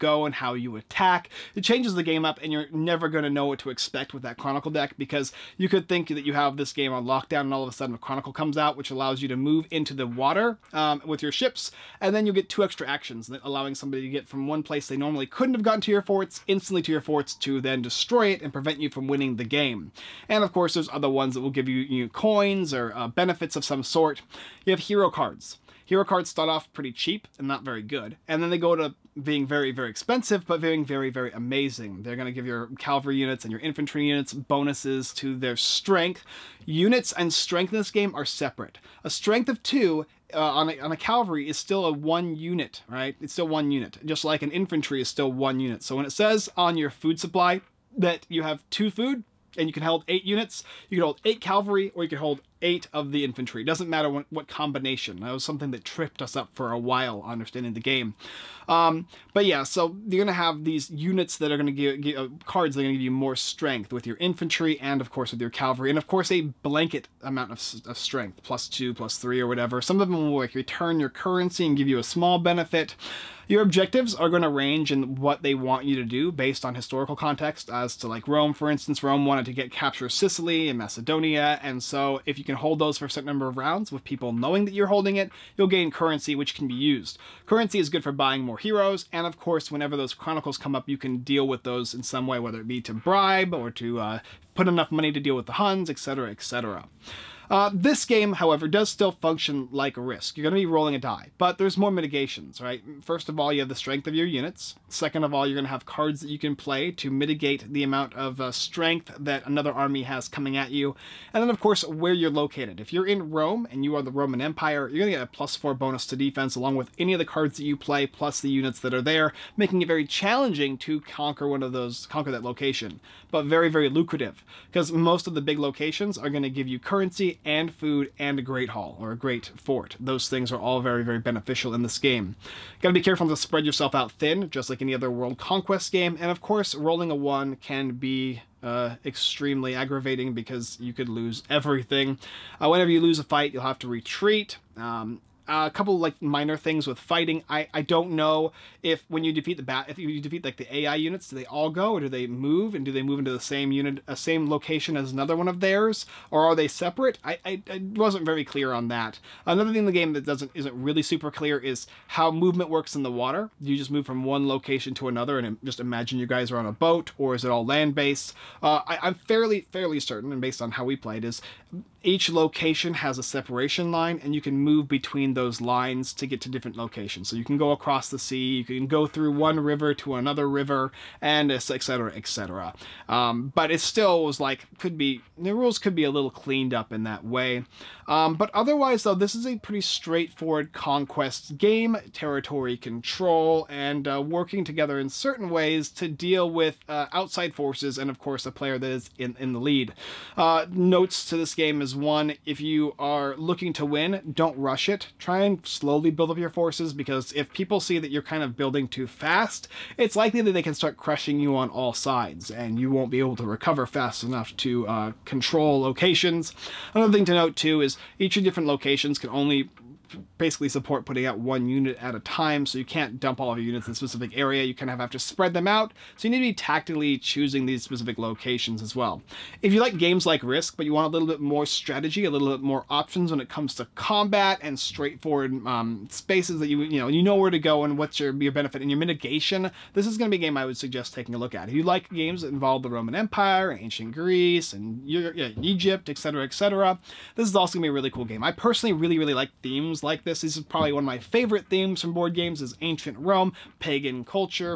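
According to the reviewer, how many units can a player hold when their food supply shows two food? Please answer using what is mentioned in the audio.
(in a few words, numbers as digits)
8.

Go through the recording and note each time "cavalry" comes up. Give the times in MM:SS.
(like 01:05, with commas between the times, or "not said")
00:32, 00:40, 00:51, 01:05.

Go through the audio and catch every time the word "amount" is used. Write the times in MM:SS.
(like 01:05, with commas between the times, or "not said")
01:07, 01:47.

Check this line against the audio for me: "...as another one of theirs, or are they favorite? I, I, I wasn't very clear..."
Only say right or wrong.
wrong.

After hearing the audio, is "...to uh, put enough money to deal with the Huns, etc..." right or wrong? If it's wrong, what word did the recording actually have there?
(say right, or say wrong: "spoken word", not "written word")
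right.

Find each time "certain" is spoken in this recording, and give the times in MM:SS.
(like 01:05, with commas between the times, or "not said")
01:23, 02:49, 03:15.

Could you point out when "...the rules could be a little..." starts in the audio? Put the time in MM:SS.
03:05.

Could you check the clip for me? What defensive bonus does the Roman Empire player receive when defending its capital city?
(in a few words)
+4.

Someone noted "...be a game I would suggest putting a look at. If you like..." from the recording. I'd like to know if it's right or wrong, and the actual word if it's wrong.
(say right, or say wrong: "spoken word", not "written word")
wrong: "taking", not "putting".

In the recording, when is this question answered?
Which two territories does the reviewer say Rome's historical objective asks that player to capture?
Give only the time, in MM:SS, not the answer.
01:20.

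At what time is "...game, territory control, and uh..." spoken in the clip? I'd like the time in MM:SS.
03:11.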